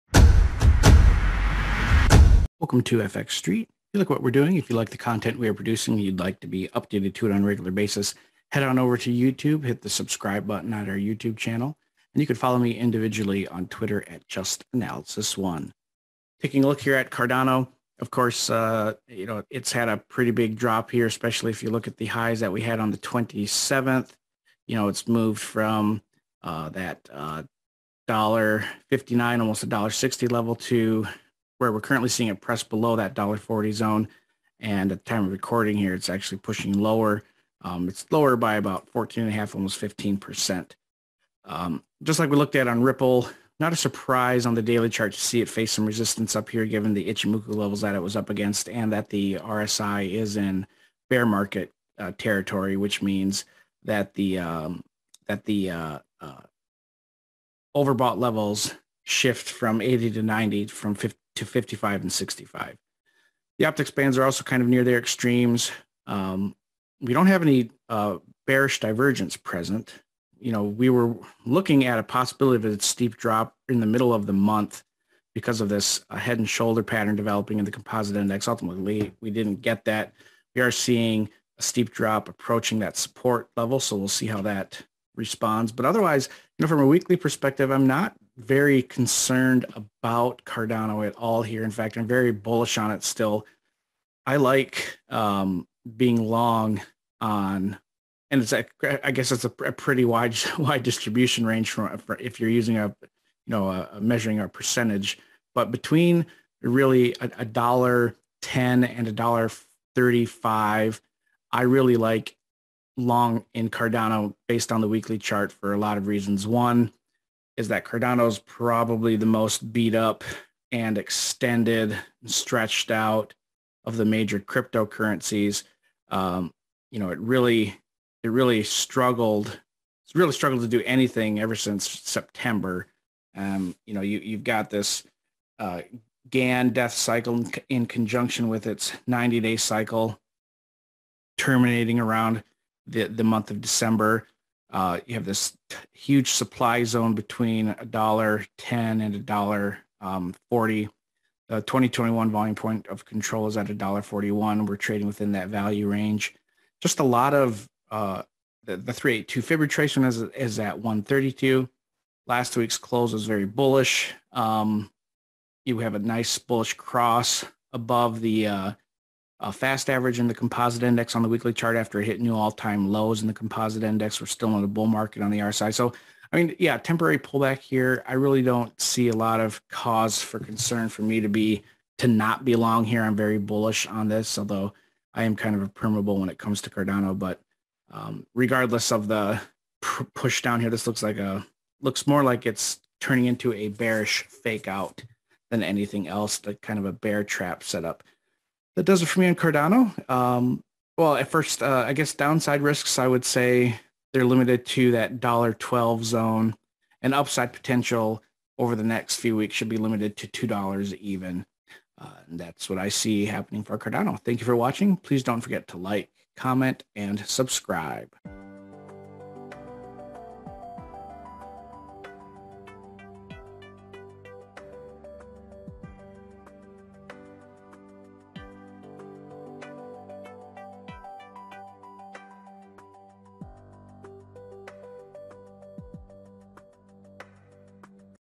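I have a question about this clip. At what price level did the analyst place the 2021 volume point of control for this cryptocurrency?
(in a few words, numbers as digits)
$1.41.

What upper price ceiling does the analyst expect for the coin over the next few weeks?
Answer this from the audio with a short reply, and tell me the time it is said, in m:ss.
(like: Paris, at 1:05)
$2, at 3:30.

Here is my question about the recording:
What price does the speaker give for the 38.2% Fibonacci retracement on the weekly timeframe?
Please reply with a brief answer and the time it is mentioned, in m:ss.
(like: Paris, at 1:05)
1.32, at 2:40.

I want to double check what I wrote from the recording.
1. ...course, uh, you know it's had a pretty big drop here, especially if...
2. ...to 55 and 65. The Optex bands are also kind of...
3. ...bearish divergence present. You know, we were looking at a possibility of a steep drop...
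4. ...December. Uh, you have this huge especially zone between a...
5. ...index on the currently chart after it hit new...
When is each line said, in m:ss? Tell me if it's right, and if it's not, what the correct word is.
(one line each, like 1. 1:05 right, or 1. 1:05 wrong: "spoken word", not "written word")
1. 0:18 right
2. 1:01 right
3. 1:08 right
4. 2:23 wrong: "supply", not "especially"
5. 2:50 wrong: "weekly", not "currently".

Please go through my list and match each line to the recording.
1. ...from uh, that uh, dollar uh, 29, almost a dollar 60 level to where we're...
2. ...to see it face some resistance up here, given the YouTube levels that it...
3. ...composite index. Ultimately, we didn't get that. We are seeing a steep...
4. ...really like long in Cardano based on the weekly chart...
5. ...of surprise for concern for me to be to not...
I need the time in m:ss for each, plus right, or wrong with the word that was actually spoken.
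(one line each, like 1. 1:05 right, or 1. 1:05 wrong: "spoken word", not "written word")
1. 0:25 wrong: "59", not "29"
2. 0:45 wrong: "Ichimoku", not "YouTube"
3. 1:17 right
4. 1:51 right
5. 2:59 wrong: "cause", not "surprise".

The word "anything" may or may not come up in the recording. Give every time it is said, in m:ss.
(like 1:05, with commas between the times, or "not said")
2:10, 3:15.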